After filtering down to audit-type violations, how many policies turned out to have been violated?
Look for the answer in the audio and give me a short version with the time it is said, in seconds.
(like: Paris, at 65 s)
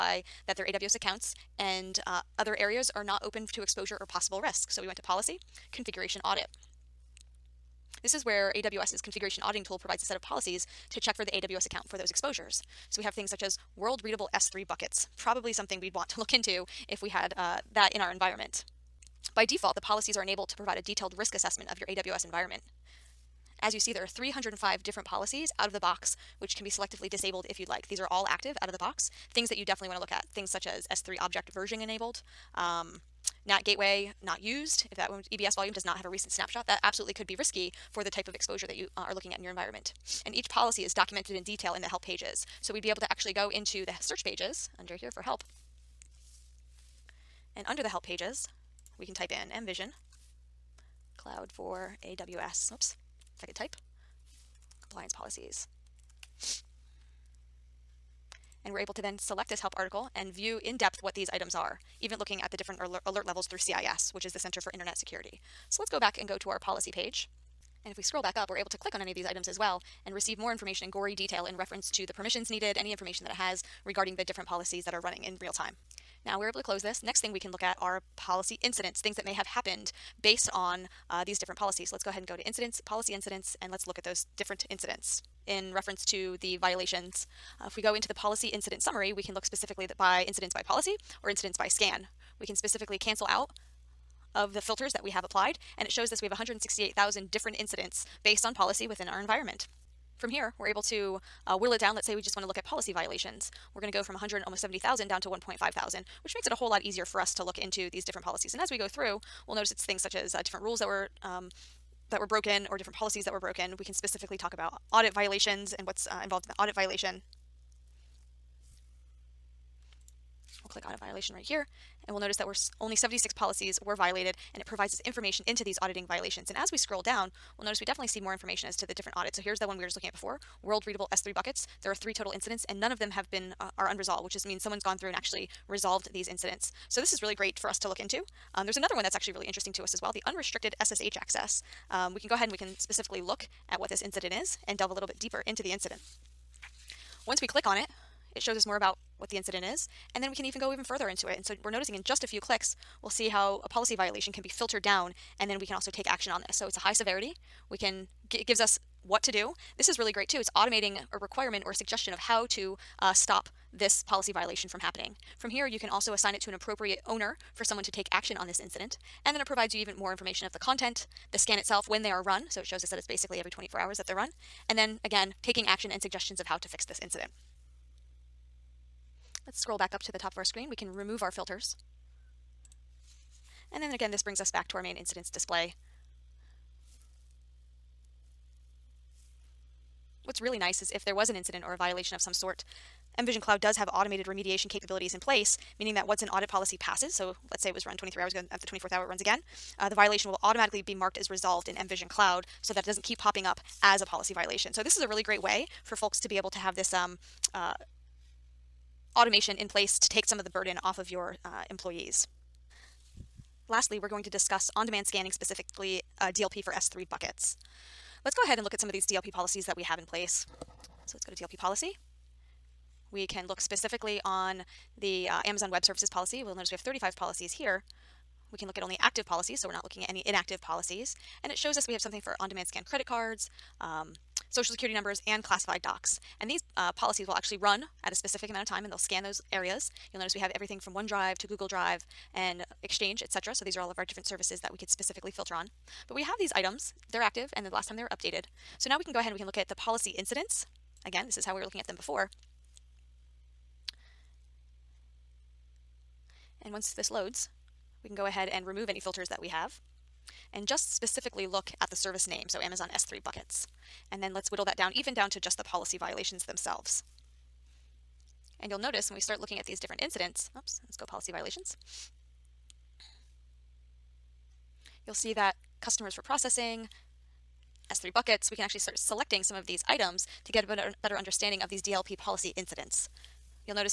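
76, at 122 s.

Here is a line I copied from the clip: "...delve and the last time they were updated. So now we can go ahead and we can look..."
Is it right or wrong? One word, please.
wrong.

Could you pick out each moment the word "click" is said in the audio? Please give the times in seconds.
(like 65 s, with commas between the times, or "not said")
68 s, 120 s, 147 s, 152 s.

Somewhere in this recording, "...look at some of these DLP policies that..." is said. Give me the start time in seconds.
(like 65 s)
218 s.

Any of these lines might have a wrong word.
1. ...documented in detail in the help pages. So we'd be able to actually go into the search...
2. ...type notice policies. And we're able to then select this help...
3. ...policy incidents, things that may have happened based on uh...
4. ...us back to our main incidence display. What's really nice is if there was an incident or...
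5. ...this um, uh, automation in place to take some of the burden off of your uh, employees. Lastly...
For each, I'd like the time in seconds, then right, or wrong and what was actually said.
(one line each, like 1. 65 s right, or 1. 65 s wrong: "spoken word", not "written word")
1. 40 s right
2. 53 s wrong: "compliance", not "notice"
3. 78 s right
4. 184 s right
5. 206 s right.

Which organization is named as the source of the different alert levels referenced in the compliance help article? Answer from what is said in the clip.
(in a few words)
Center for Internet Security.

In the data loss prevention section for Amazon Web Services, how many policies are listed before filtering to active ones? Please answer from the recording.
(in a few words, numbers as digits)
35.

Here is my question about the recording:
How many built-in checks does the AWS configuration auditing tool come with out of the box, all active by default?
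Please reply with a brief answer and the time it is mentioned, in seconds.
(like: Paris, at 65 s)
305, at 24 s.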